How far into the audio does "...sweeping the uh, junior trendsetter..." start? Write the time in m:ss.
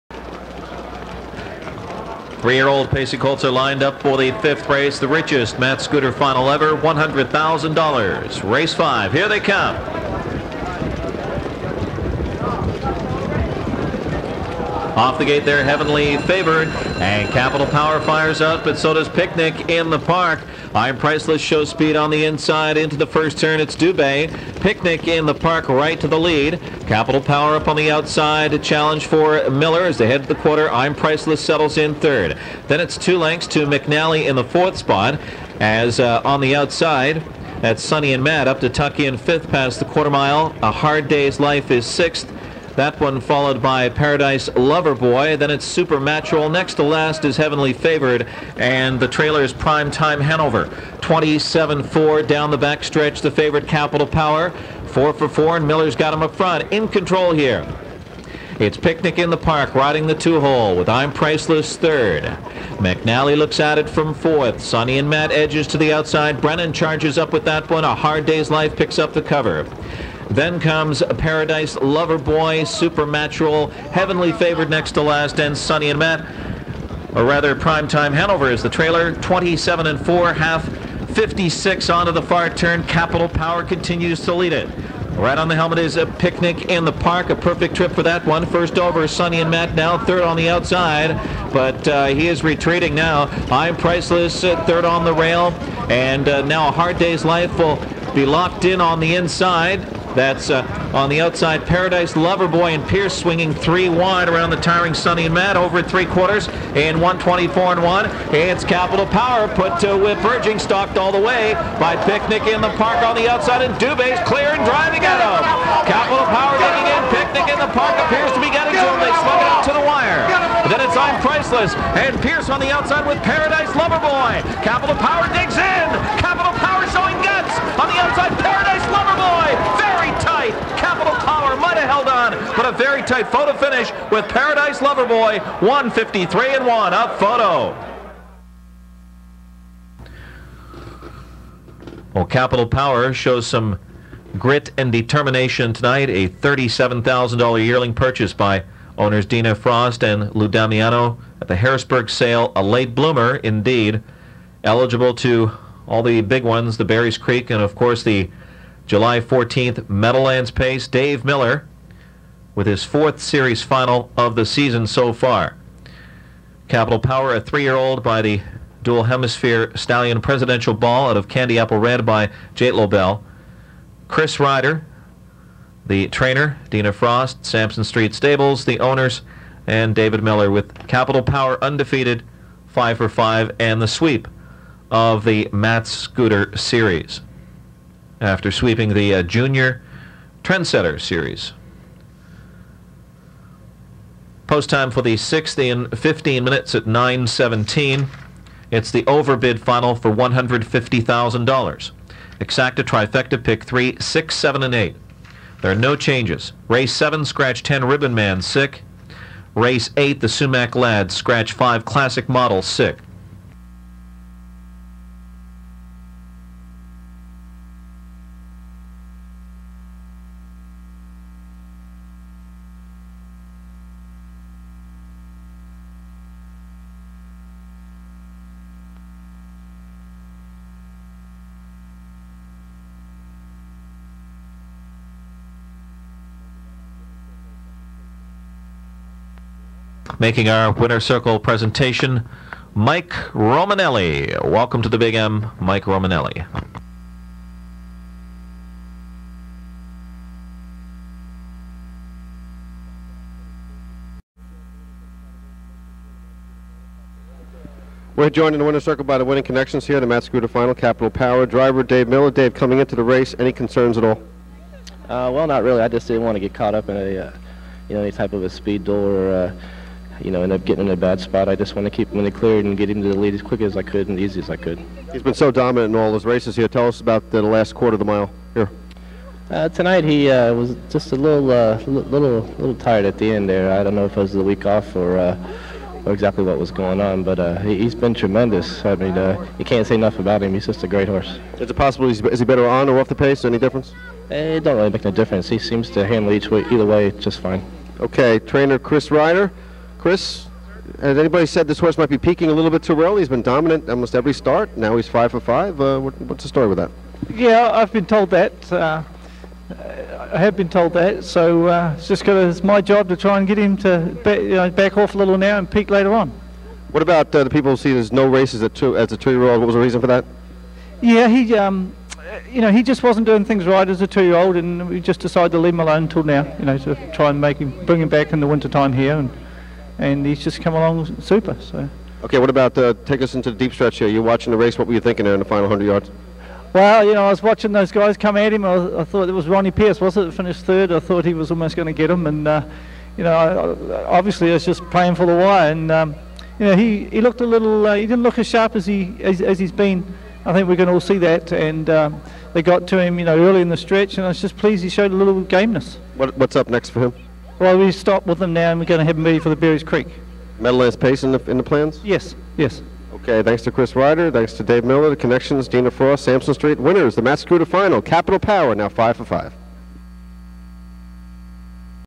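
3:08.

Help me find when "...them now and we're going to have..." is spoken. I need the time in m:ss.
5:58.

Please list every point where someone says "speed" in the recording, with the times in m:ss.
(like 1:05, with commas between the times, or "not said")
0:21, 4:28.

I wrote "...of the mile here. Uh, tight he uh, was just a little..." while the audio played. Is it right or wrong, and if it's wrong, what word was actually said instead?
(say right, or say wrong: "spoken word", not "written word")
wrong: "tonight", not "tight".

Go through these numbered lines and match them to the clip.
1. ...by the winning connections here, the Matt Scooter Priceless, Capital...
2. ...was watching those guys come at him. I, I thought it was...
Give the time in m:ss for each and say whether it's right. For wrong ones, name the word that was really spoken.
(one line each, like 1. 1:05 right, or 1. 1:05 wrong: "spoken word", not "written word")
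1. 4:19 wrong: "Final", not "Priceless"
2. 5:37 right.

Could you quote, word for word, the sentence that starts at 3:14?
Post time for the sixth and 15 minutes at 9.17.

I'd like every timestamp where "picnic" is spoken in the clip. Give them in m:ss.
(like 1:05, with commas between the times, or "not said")
0:19, 0:24, 0:58, 1:26, 1:52, 1:57.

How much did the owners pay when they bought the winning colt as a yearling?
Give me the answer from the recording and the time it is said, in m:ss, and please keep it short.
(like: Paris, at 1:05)
$37,000, at 2:26.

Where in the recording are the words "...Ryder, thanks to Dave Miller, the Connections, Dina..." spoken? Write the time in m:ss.
6:03.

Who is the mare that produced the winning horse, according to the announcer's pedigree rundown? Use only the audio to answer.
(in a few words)
Candy Apple Red.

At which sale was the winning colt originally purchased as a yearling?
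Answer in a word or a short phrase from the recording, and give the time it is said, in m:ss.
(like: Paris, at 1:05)
Harrisburg, at 2:31.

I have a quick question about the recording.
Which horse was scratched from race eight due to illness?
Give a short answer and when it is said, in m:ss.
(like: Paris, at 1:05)
Classic Model, at 3:31.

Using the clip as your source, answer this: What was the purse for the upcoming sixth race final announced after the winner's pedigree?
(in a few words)
$150,000.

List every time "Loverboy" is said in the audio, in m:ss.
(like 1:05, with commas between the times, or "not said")
0:44, 1:11, 1:42, 2:03, 2:14.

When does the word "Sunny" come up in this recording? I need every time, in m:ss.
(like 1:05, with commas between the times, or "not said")
0:37, 1:15, 1:44.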